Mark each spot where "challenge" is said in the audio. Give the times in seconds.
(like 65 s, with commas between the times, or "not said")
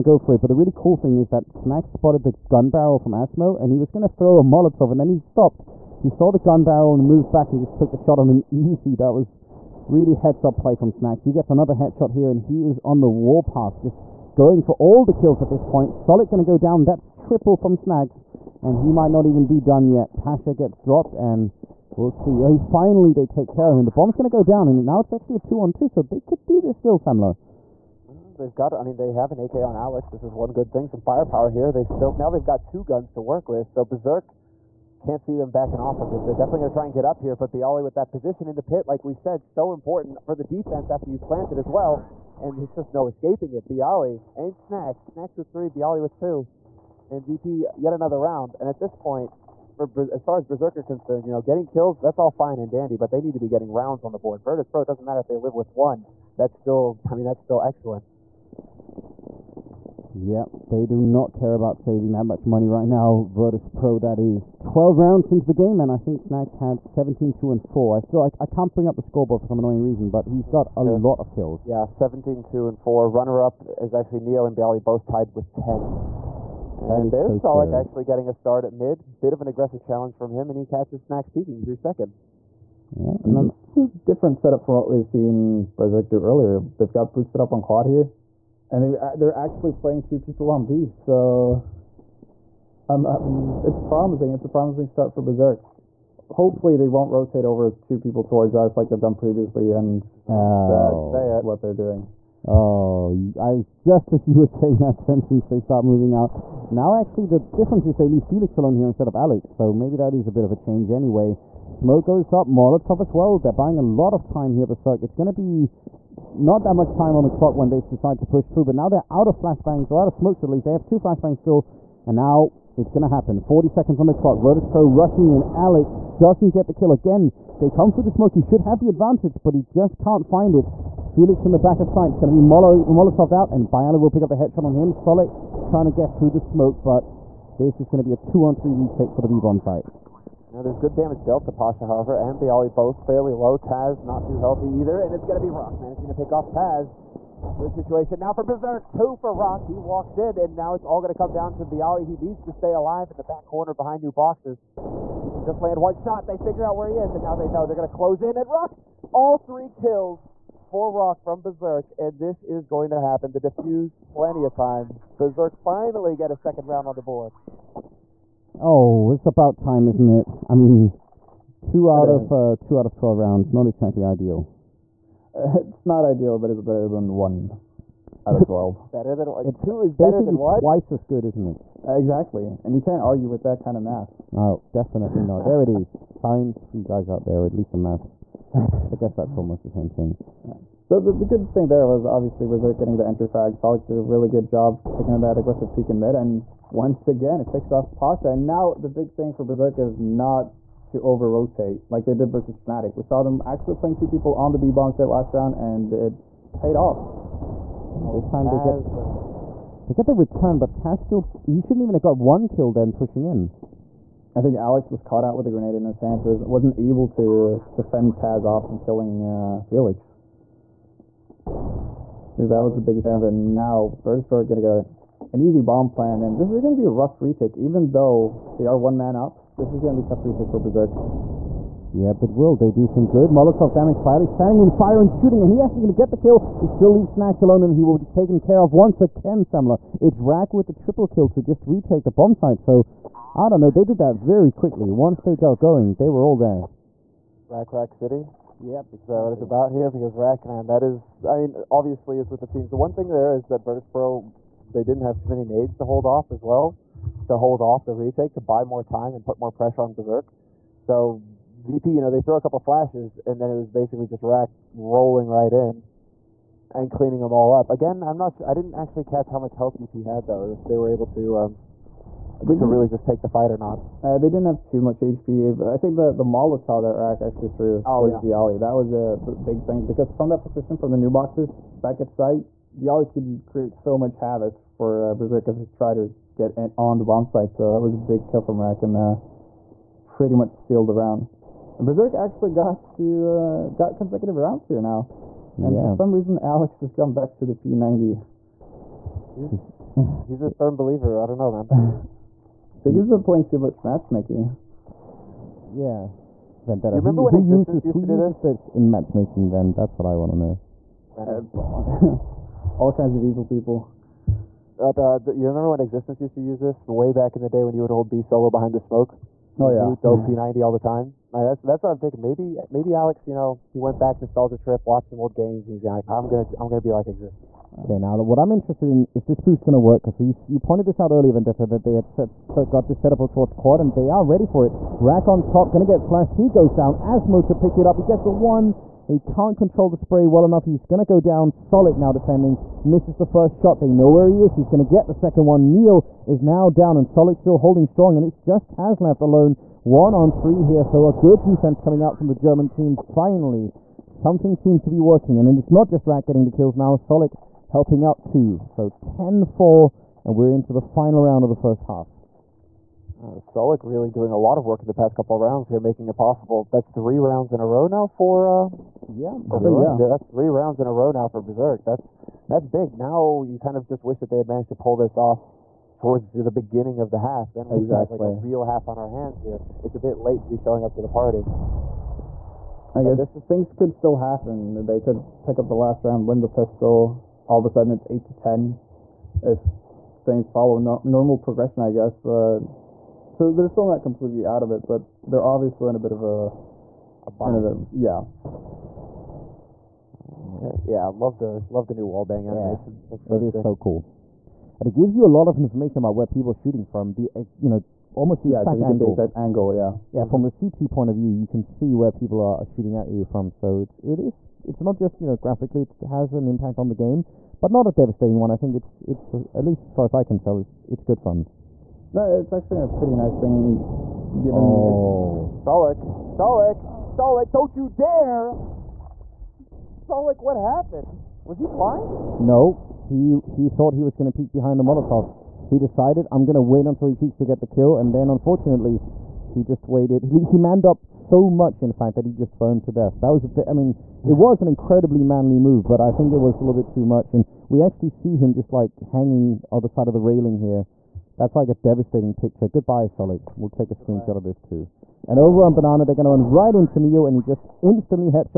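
79 s, 223 s.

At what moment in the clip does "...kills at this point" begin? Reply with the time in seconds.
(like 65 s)
15 s.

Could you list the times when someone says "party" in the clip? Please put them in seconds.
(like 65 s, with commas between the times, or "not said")
381 s.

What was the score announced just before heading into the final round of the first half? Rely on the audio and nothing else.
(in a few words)
10-4.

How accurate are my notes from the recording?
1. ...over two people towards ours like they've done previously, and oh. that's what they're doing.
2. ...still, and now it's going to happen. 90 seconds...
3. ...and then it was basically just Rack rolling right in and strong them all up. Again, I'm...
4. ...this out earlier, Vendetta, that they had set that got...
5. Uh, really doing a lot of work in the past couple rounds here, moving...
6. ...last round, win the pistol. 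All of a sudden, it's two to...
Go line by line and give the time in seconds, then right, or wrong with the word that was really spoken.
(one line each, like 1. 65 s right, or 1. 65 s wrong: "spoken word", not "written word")
1. 97 s right
2. 121 s wrong: "40", not "90"
3. 263 s wrong: "cleaning", not "strong"
4. 330 s right
5. 363 s wrong: "making", not "moving"
6. 385 s wrong: "eight", not "two".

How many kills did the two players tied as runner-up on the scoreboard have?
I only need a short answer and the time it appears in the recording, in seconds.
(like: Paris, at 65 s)
10, at 75 s.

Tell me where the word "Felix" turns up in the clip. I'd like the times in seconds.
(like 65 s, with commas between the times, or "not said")
108 s, 130 s, 219 s.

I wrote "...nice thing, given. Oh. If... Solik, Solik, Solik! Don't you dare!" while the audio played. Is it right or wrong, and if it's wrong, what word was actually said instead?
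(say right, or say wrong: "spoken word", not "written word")
right.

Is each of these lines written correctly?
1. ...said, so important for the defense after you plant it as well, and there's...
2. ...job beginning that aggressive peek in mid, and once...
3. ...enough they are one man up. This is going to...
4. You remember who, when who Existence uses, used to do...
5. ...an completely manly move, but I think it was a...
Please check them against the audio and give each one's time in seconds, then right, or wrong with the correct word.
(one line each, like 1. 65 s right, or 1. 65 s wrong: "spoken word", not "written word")
1. 39 s right
2. 194 s wrong: "taking", not "beginning"
3. 227 s wrong: "though", not "enough"
4. 306 s right
5. 444 s wrong: "incredibly", not "completely".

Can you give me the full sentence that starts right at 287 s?
So that was a big kill from Rack and uh, pretty much sealed the round.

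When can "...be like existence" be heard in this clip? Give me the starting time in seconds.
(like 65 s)
326 s.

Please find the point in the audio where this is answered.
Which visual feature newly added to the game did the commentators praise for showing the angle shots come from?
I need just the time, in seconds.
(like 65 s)
402 s.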